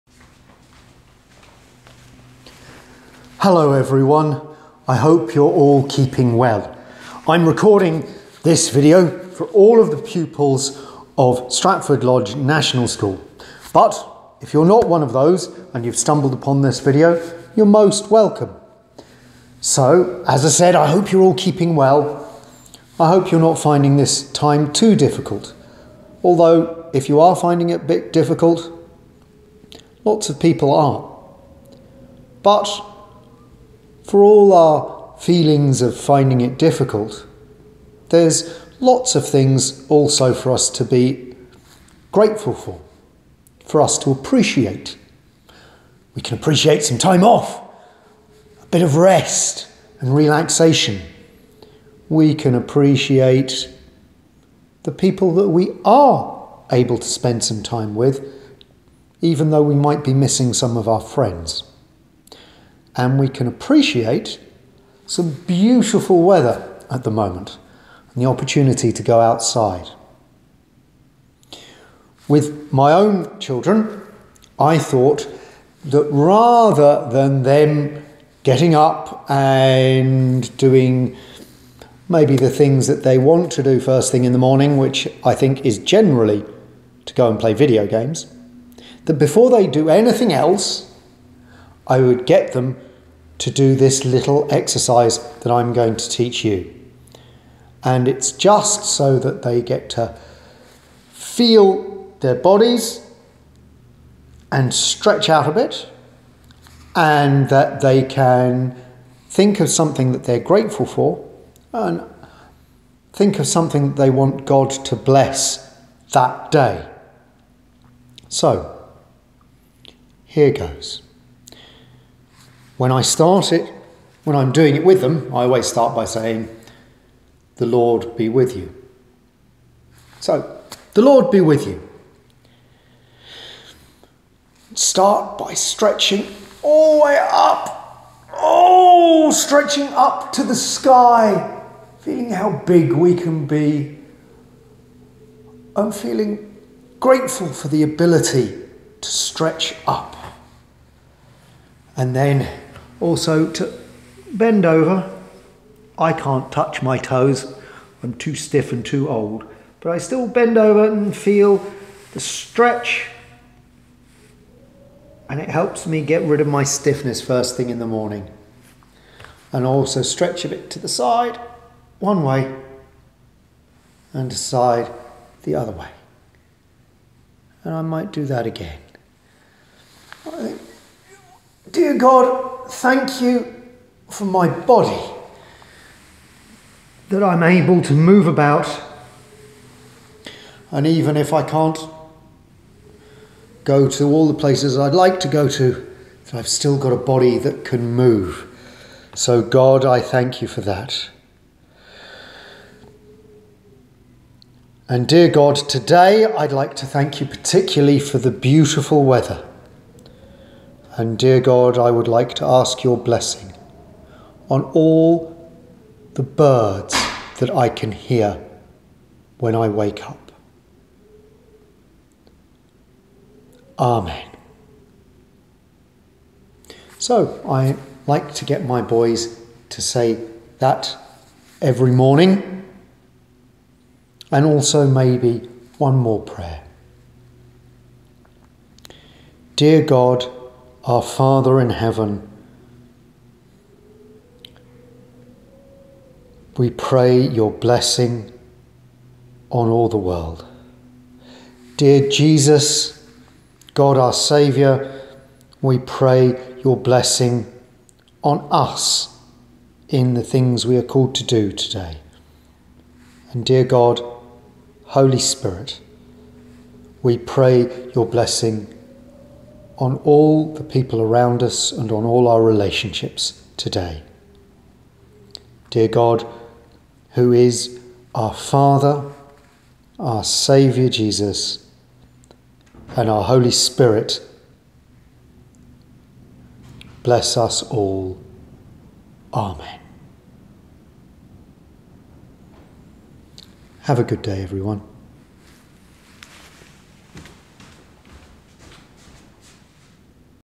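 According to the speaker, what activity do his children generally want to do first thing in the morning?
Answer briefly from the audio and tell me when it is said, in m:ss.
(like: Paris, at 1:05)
play video games, at 1:27.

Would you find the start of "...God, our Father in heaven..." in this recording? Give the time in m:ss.
3:59.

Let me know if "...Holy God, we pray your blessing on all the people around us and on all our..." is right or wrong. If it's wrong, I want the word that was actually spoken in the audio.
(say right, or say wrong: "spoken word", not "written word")
wrong: "Spirit", not "God".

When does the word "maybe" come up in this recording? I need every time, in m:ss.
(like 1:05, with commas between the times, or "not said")
1:22, 3:54.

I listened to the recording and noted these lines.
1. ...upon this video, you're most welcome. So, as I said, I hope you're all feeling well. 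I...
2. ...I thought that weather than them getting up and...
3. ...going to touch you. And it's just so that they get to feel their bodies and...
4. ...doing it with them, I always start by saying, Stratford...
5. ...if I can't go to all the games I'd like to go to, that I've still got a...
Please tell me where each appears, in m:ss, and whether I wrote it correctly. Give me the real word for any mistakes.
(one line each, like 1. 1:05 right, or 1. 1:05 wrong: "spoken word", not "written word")
1. 0:16 wrong: "keeping", not "feeling"
2. 1:14 wrong: "rather", not "weather"
3. 1:35 wrong: "teach", not "touch"
4. 2:04 wrong: "The", not "Stratford"
5. 3:11 wrong: "places", not "games".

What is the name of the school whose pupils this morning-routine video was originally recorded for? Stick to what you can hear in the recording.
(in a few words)
Stratford Lodge National School.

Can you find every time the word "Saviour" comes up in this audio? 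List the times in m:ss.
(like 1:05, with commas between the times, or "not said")
4:14, 4:40.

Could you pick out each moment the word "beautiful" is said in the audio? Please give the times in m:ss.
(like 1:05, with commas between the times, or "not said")
1:05, 3:28.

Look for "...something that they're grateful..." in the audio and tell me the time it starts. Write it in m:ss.
1:49.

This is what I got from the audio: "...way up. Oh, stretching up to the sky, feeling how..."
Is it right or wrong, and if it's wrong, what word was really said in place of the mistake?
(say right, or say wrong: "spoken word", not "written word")
right.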